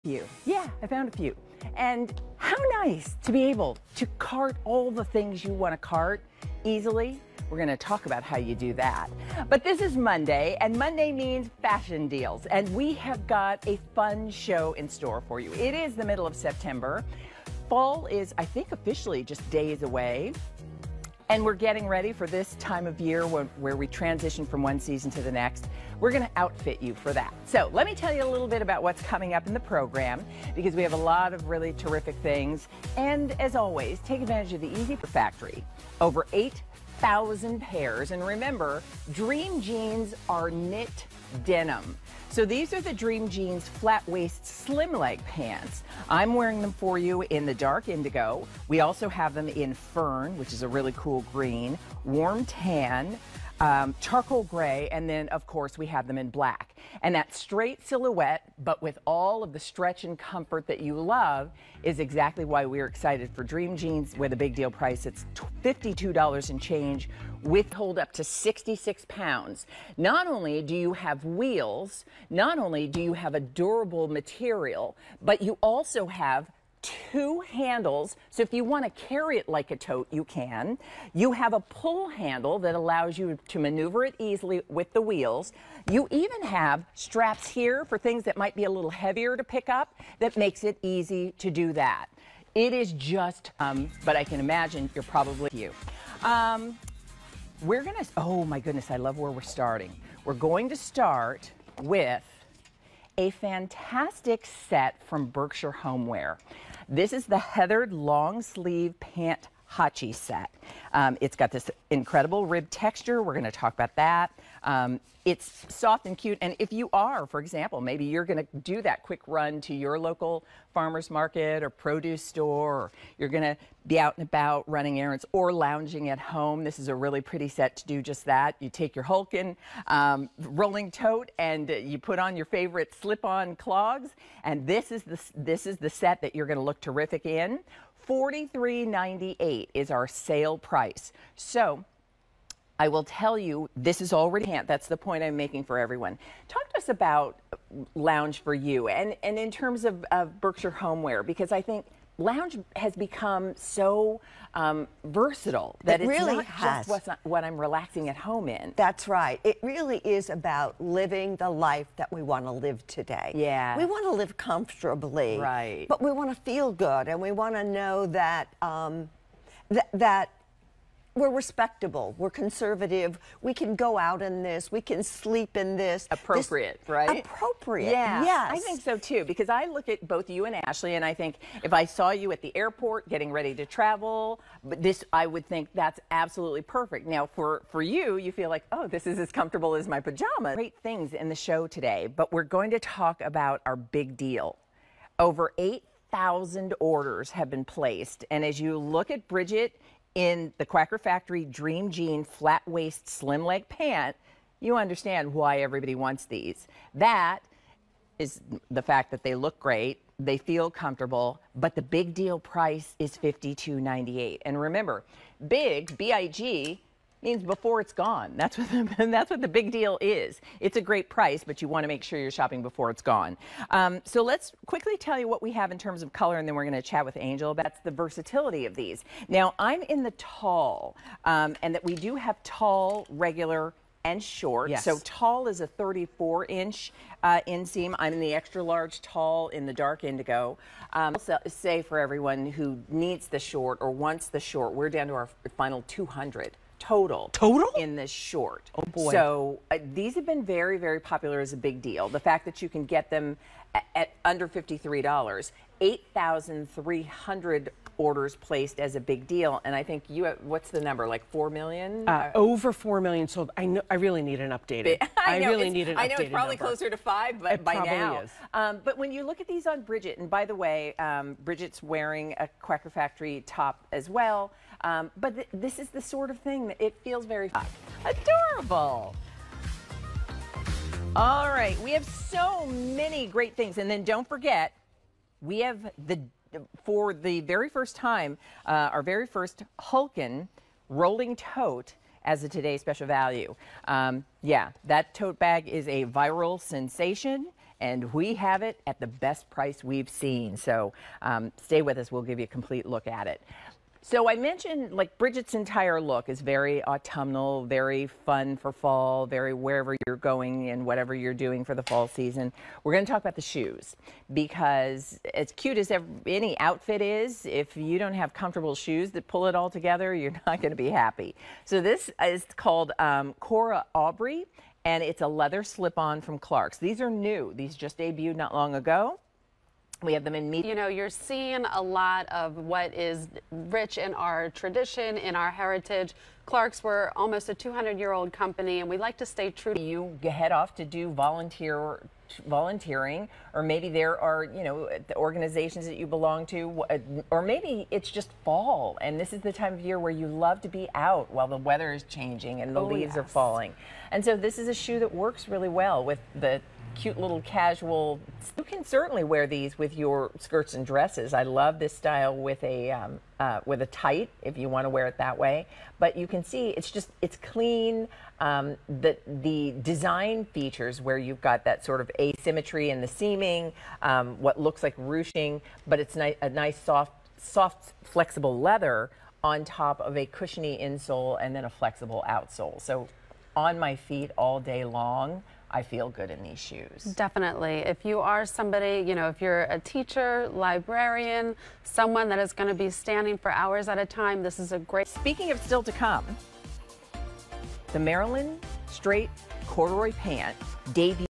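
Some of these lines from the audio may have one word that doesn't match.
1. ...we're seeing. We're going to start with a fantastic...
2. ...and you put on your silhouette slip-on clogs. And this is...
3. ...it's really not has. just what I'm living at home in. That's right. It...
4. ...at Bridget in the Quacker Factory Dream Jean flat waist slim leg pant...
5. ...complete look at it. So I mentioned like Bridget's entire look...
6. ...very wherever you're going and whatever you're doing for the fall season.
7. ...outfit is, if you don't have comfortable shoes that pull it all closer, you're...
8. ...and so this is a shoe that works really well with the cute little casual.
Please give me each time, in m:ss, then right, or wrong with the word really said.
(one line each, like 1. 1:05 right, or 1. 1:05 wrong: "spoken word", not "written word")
1. 1:39 wrong: "starting", not "seeing"
2. 2:11 wrong: "favorite", not "silhouette"
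3. 2:36 wrong: "relaxing", not "living"
4. 3:19 right
5. 5:02 right
6. 5:09 right
7. 5:16 wrong: "together", not "closer"
8. 5:54 right.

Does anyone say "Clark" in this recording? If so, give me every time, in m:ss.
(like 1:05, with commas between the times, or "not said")
5:26, 5:36.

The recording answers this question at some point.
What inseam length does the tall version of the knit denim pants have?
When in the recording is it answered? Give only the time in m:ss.
3:55.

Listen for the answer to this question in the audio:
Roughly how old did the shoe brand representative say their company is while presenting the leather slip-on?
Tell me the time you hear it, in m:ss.
5:37.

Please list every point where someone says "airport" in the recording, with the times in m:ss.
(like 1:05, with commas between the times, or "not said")
3:02.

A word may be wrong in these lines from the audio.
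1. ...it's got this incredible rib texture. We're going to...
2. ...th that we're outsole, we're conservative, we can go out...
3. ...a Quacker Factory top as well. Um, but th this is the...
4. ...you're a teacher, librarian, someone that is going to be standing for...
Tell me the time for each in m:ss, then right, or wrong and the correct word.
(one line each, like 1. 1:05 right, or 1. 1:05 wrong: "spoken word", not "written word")
1. 1:51 right
2. 2:49 wrong: "respectable", not "outsole"
3. 4:32 right
4. 6:29 right.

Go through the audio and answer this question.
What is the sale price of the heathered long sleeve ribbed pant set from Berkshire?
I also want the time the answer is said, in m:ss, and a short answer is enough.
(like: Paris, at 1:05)
$43.98, at 2:18.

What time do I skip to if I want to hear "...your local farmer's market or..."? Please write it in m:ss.
1:59.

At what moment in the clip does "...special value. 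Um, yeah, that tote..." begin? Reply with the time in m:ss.
4:52.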